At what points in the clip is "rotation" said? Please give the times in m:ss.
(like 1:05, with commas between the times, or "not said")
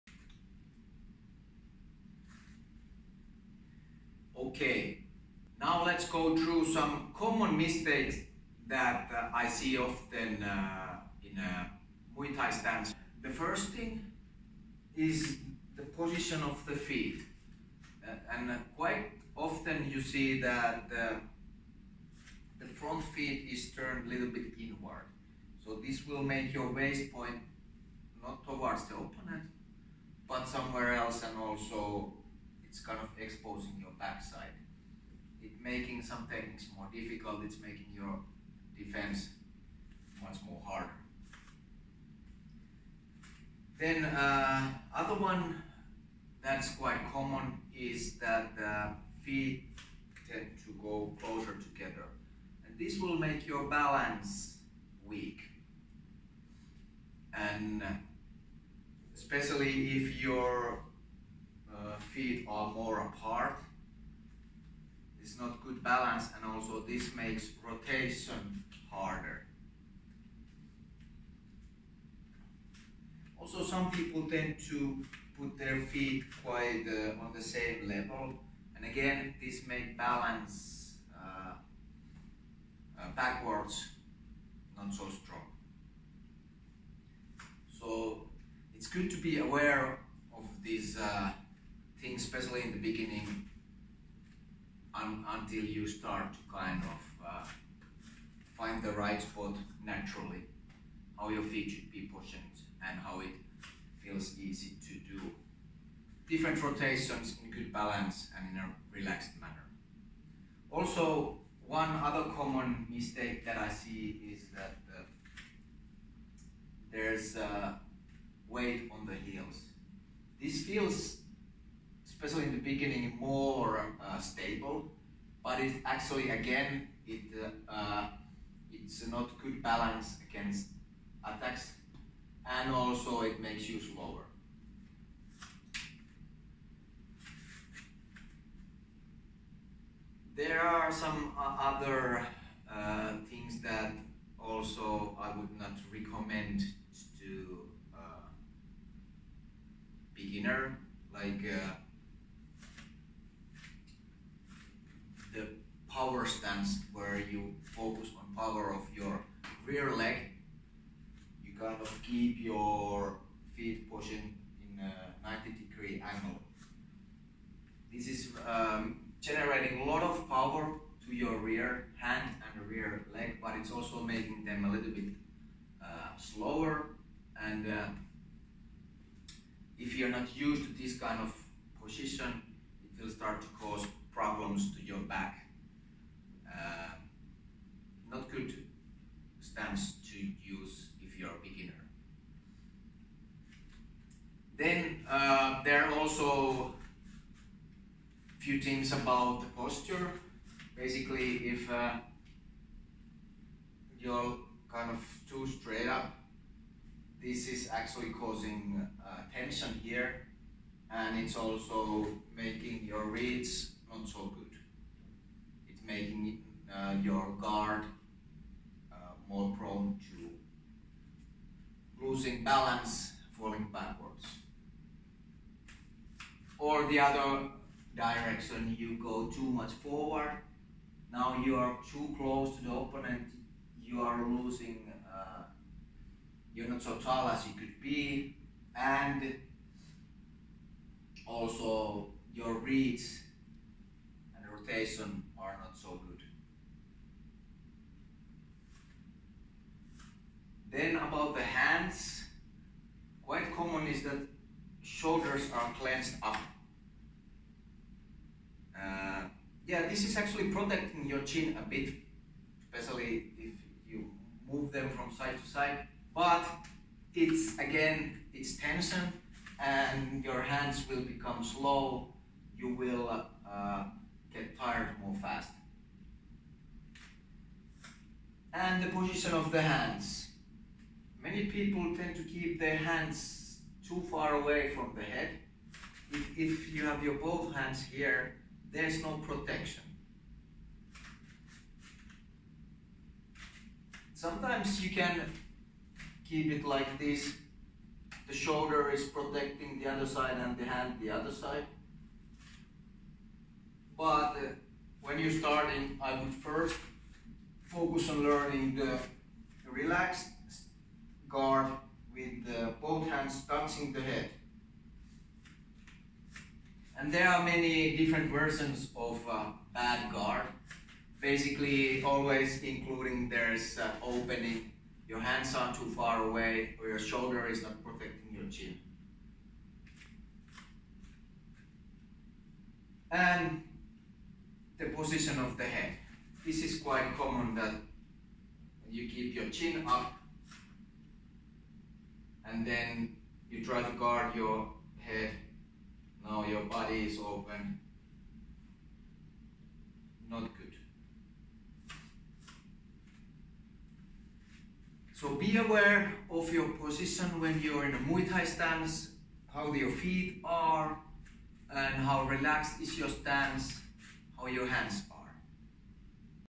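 1:07, 1:46, 4:04.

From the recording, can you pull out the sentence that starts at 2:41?
You kind of keep your feet position in a 90 degree angle.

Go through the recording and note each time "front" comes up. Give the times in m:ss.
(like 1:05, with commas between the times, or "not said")
0:22.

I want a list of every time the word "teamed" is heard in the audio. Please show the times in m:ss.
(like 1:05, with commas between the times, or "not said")
not said.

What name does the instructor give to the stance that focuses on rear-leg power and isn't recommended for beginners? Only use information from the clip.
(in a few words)
Power stance.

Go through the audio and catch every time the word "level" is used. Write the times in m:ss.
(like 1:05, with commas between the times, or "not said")
1:17.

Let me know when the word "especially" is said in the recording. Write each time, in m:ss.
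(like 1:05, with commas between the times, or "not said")
0:59, 1:32, 2:02, 4:22.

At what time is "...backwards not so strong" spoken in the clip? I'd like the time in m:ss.
1:23.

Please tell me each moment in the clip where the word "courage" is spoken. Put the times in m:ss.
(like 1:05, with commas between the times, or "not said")
not said.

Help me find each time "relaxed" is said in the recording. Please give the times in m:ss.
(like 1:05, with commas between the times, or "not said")
1:48, 5:09, 6:02.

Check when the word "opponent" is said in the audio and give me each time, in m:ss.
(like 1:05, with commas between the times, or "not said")
0:28, 3:52.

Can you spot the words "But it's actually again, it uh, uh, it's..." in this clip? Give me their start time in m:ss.
2:05.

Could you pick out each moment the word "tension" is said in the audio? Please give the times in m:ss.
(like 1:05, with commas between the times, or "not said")
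3:29, 4:28.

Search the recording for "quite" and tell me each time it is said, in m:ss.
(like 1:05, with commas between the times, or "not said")
0:18, 0:46, 1:16, 4:13, 5:36.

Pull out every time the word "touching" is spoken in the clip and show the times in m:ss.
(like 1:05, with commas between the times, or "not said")
5:13.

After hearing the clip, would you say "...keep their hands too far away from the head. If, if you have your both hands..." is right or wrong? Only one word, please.
right.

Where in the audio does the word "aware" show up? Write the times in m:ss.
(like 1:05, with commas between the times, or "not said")
1:29, 5:55.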